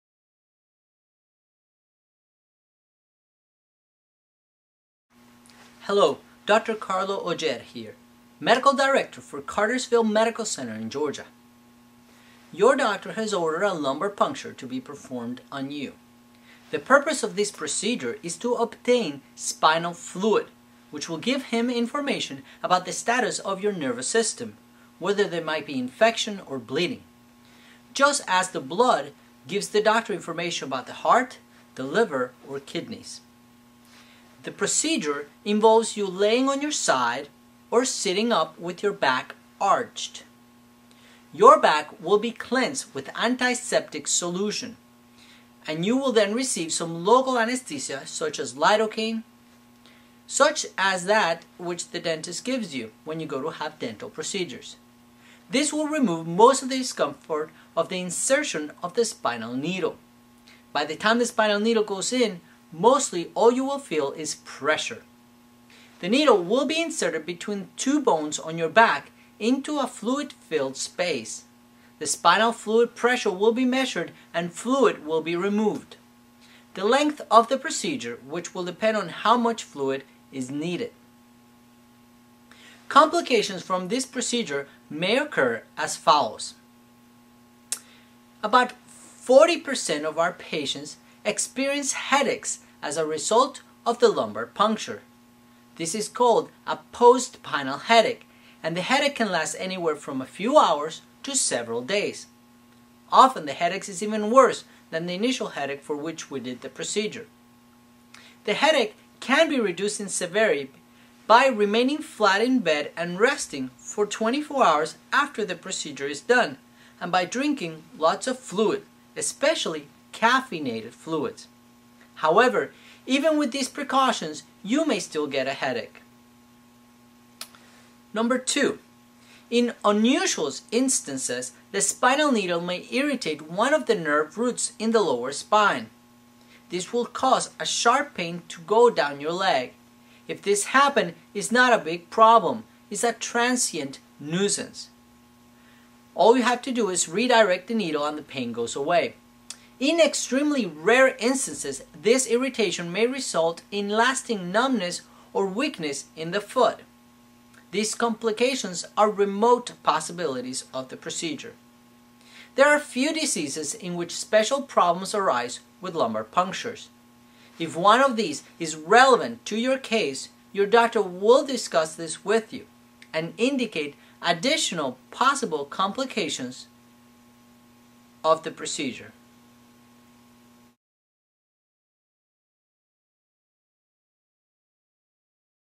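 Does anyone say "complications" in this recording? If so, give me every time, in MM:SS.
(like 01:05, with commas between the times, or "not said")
01:22, 02:37, 02:55.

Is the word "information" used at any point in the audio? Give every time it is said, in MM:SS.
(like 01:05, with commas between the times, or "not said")
00:21, 00:30.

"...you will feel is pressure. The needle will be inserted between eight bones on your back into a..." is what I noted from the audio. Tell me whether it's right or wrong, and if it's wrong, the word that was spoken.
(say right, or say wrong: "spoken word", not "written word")
wrong: "two", not "eight".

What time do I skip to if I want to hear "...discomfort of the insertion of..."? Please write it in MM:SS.
00:56.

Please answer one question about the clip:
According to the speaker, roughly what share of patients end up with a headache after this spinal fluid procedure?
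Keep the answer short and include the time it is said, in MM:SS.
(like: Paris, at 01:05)
40%, at 01:29.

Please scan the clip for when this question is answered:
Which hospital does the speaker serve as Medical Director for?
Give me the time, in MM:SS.
00:09.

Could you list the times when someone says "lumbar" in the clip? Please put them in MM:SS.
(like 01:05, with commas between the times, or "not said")
00:13, 01:34, 02:45.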